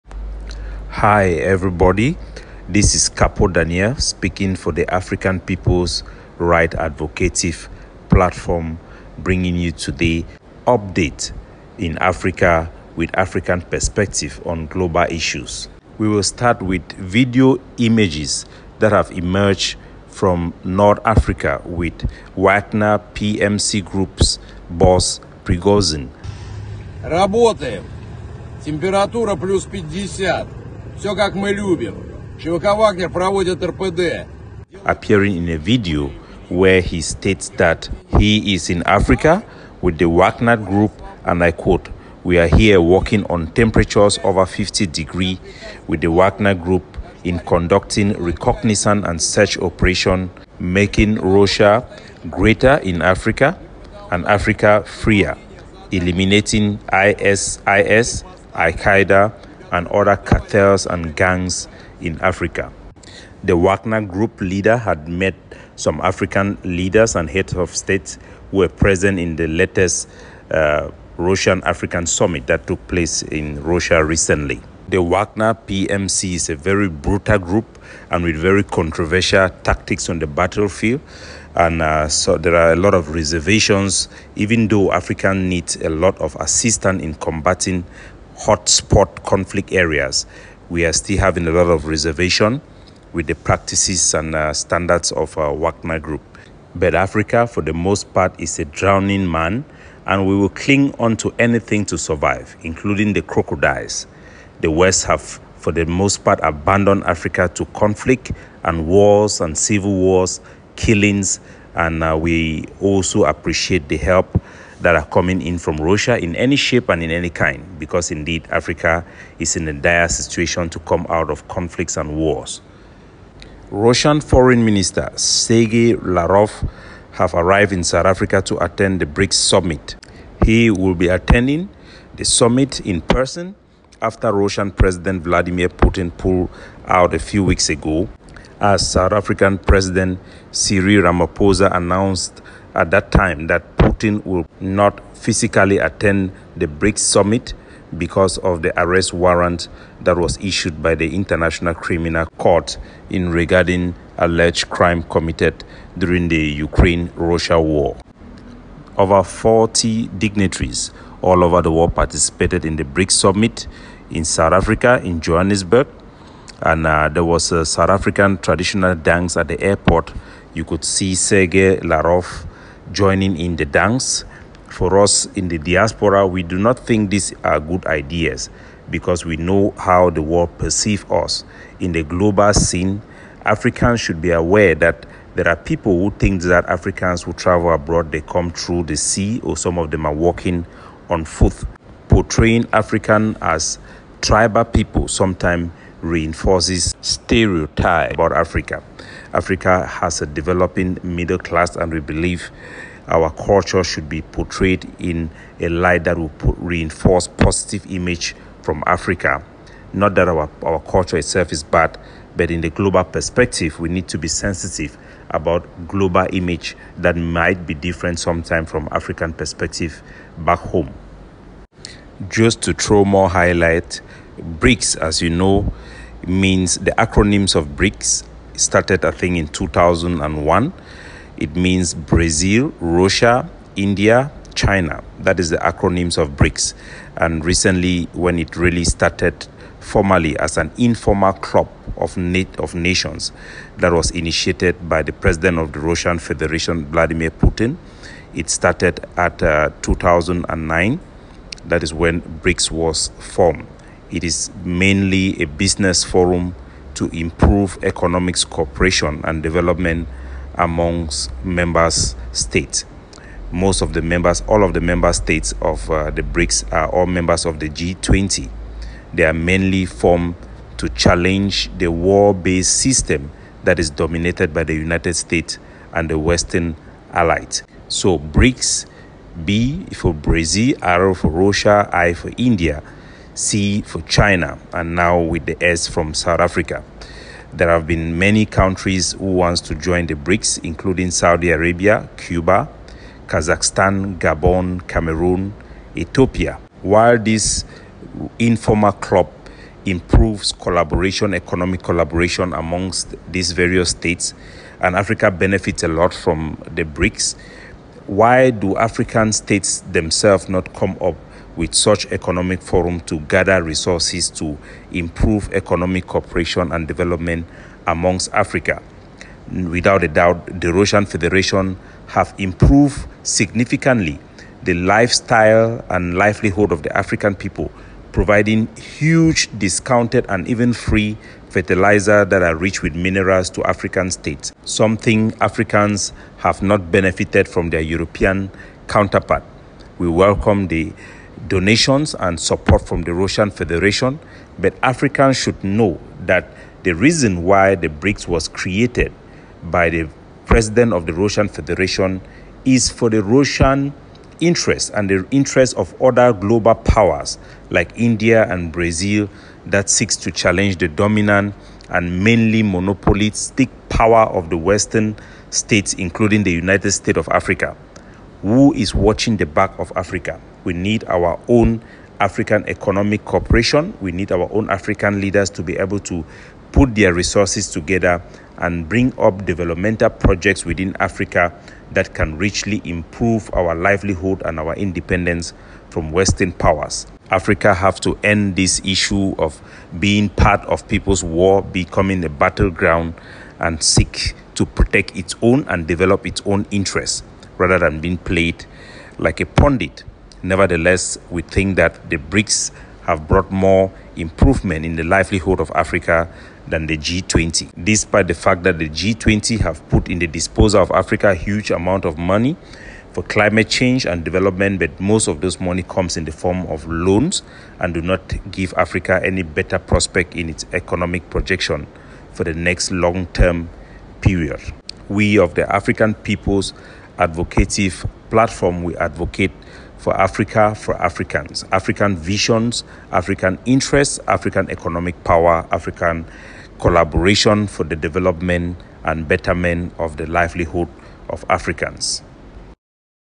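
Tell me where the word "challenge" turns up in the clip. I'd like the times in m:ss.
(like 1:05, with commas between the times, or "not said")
4:30, 6:00.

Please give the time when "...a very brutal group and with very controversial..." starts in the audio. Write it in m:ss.
1:16.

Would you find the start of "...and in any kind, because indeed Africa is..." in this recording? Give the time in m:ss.
1:56.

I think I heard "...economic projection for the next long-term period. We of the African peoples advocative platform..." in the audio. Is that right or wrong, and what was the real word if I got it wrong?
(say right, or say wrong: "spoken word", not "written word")
right.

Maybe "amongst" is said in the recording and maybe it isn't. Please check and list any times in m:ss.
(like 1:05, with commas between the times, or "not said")
4:20, 5:02, 5:17.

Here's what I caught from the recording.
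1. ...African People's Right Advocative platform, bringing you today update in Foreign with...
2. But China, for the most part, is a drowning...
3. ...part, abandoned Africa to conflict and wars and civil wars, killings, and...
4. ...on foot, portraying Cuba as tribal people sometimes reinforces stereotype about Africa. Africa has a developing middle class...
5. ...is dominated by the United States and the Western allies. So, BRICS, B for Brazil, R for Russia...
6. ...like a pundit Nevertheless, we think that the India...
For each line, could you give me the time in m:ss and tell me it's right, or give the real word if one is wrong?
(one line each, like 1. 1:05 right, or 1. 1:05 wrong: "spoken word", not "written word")
1. 0:04 wrong: "Africa", not "Foreign"
2. 1:36 wrong: "Africa", not "China"
3. 1:46 right
4. 3:11 wrong: "African", not "Cuba"
5. 4:33 right
6. 6:39 wrong: "BRICS", not "India".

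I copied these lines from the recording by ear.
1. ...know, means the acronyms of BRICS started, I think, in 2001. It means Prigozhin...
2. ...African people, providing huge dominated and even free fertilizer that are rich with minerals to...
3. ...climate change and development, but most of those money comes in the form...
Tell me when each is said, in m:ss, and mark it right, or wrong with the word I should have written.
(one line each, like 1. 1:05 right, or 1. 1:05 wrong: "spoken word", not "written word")
1. 3:45 wrong: "Brazil", not "Prigozhin"
2. 5:26 wrong: "discounted", not "dominated"
3. 6:53 right.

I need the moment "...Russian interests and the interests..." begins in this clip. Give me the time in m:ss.
5:53.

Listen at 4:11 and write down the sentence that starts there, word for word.
That is when BRICS was formed.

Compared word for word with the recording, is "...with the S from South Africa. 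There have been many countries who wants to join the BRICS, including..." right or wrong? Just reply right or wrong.
right.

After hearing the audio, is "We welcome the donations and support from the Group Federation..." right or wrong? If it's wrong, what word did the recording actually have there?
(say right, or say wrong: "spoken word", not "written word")
wrong: "Russian", not "Group".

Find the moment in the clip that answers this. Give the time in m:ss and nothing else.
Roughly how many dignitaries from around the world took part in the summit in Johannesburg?
2:38.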